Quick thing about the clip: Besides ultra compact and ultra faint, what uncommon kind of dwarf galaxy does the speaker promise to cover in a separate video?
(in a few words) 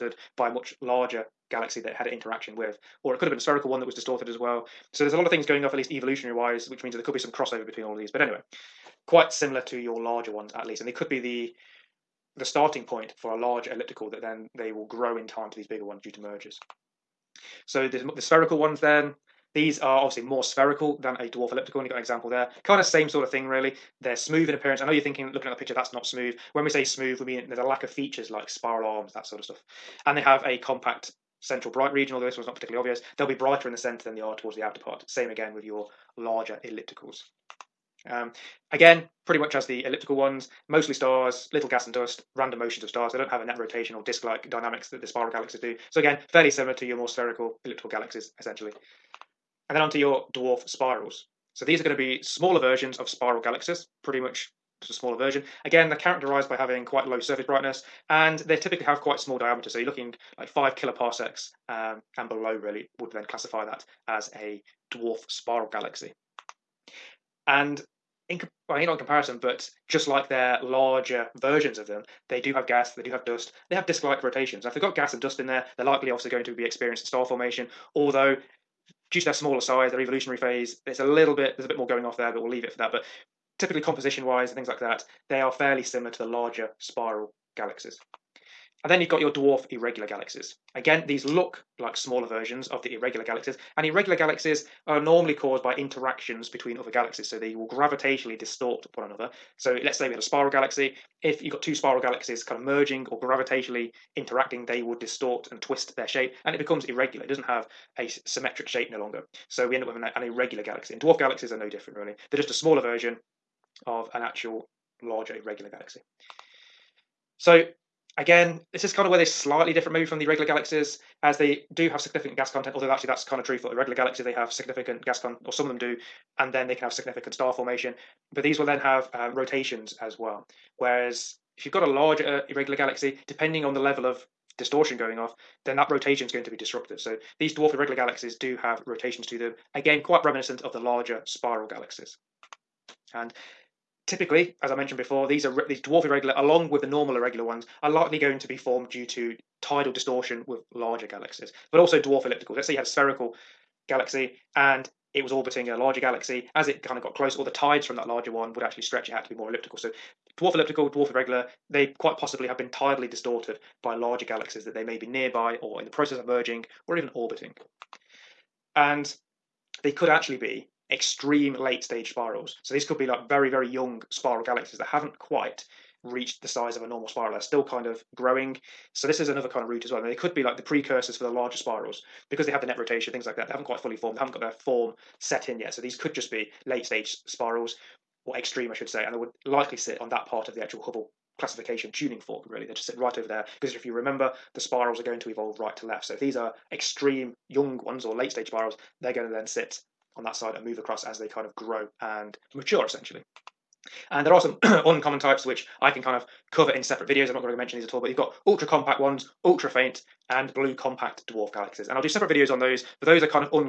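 Blue compact dwarf.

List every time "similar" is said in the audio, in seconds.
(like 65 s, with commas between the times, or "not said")
9 s, 46 s, 85 s.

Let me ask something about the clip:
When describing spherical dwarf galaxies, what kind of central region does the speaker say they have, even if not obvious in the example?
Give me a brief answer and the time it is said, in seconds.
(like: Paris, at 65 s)
Compact central bright region, at 30 s.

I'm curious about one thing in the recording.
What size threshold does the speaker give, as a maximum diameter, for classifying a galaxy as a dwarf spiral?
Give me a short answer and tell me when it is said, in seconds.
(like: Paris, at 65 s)
5 kiloparsecs, at 60 s.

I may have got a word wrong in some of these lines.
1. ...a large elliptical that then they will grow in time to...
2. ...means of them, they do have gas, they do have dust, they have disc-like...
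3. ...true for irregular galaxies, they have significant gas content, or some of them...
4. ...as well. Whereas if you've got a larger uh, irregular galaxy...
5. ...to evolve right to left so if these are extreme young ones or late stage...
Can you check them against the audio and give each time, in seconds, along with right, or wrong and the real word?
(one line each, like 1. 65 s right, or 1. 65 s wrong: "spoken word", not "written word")
1. 13 s right
2. 71 s wrong: "versions", not "means"
3. 123 s right
4. 130 s right
5. 195 s right.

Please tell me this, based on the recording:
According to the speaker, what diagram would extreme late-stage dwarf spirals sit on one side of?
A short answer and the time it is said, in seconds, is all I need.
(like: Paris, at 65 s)
Hubble classification tuning fork, at 190 s.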